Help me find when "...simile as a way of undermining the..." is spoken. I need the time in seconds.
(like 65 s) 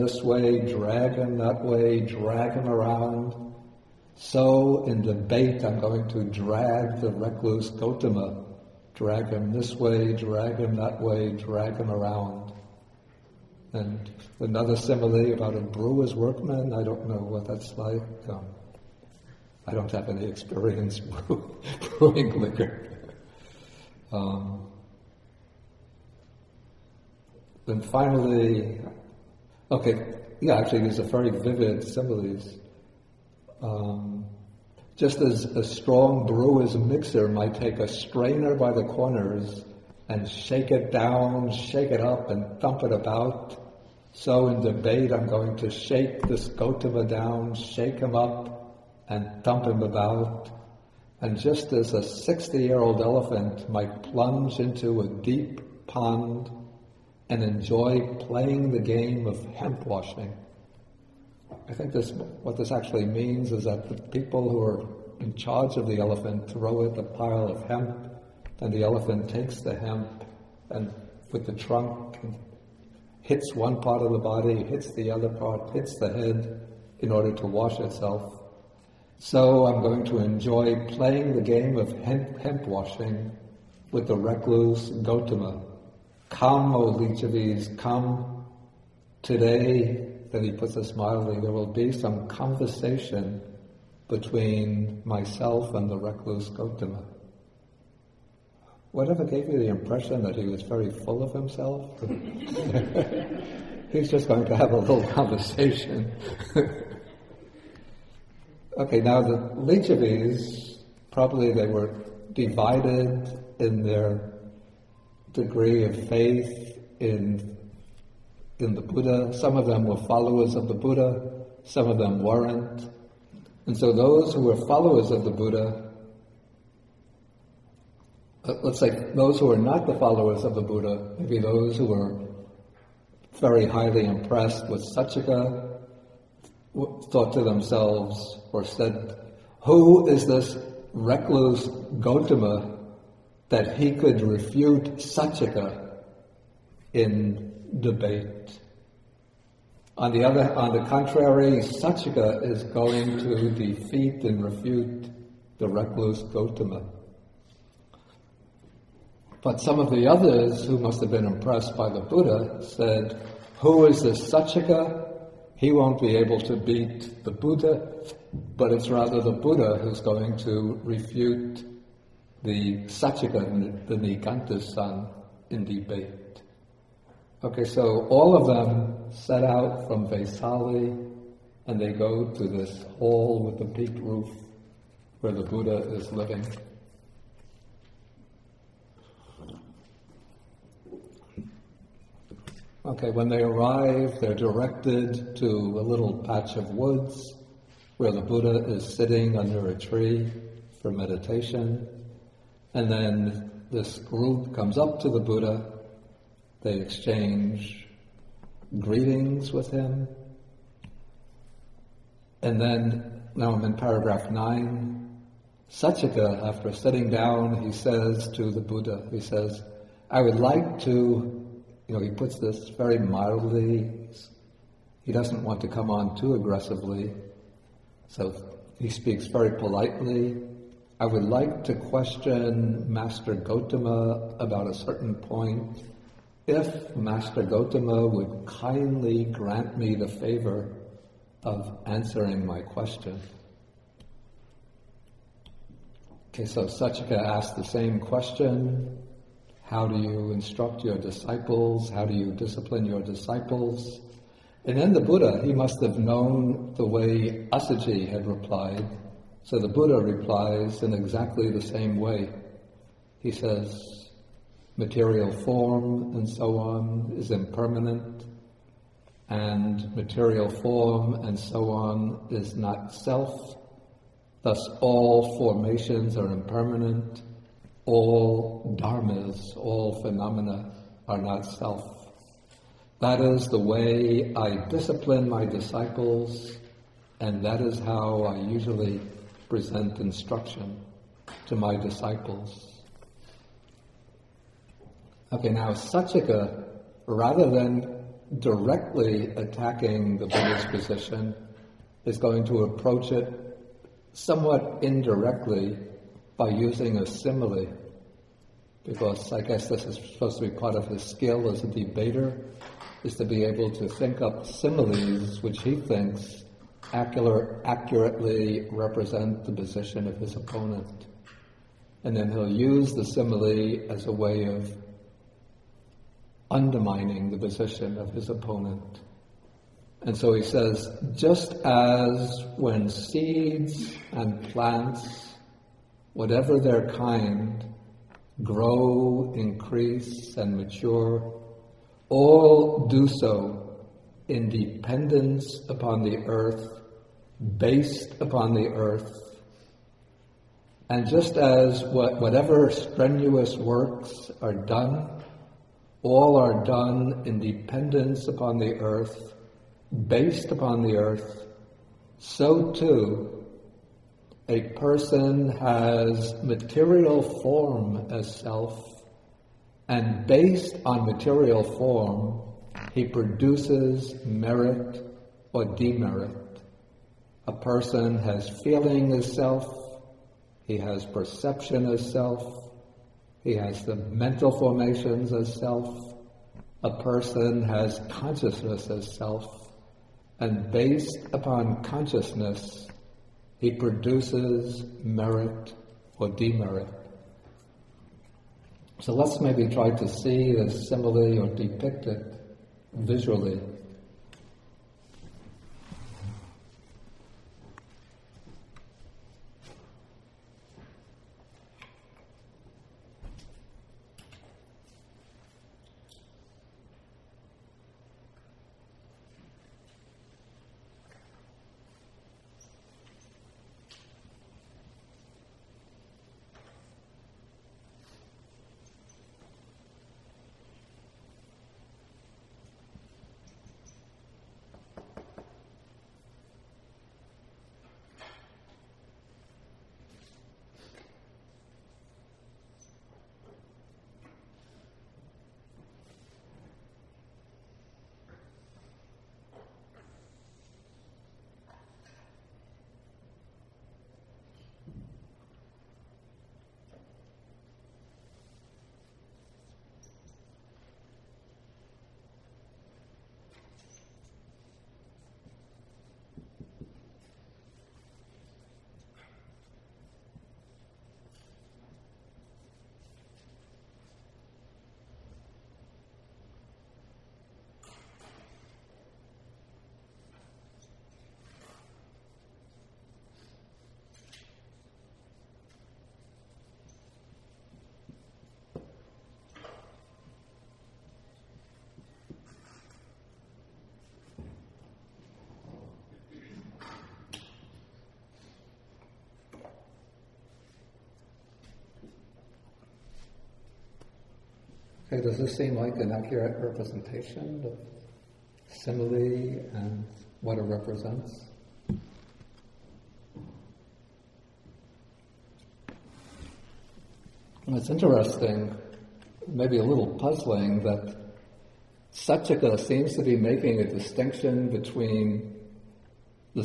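323 s.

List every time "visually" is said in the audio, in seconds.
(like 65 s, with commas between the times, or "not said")
402 s.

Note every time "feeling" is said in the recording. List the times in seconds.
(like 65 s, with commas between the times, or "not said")
378 s.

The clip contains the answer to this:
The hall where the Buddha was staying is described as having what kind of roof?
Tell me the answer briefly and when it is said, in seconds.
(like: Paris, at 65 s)
Peaked roof, at 183 s.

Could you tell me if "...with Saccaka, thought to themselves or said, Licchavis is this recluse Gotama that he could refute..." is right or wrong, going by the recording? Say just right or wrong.
wrong.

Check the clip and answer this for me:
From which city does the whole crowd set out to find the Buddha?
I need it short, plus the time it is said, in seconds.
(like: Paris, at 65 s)
Vaisali, at 180 s.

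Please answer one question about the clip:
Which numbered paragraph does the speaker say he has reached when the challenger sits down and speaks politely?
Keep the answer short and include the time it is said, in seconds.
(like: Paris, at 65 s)
9, at 213 s.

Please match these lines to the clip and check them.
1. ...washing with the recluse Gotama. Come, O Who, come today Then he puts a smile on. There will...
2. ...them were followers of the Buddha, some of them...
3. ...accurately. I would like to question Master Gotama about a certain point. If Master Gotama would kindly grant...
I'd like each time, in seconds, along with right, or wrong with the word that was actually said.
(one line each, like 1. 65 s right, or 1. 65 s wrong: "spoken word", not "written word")
1. 82 s wrong: "Licchavis", not "Who"
2. 119 s right
3. 229 s wrong: "politely", not "accurately".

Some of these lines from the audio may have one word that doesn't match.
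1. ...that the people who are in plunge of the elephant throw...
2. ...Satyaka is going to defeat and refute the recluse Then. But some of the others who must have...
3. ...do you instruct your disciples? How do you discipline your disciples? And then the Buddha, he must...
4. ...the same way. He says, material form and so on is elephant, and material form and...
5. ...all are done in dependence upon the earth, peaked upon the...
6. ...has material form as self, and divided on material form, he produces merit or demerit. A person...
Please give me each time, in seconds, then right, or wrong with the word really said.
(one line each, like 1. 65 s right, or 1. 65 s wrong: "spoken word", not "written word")
1. 63 s wrong: "charge", not "plunge"
2. 151 s wrong: "Gotama", not "Then"
3. 249 s right
4. 261 s wrong: "impermanent", not "elephant"
5. 356 s wrong: "based", not "peaked"
6. 365 s wrong: "based", not "divided".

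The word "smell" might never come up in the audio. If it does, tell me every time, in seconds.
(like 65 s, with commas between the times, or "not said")
not said.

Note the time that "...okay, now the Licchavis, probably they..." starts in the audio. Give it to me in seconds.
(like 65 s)
108 s.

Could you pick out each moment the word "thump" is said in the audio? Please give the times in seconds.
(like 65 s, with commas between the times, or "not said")
42 s, 49 s.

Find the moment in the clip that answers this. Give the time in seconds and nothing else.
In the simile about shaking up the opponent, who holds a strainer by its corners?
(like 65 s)
36 s.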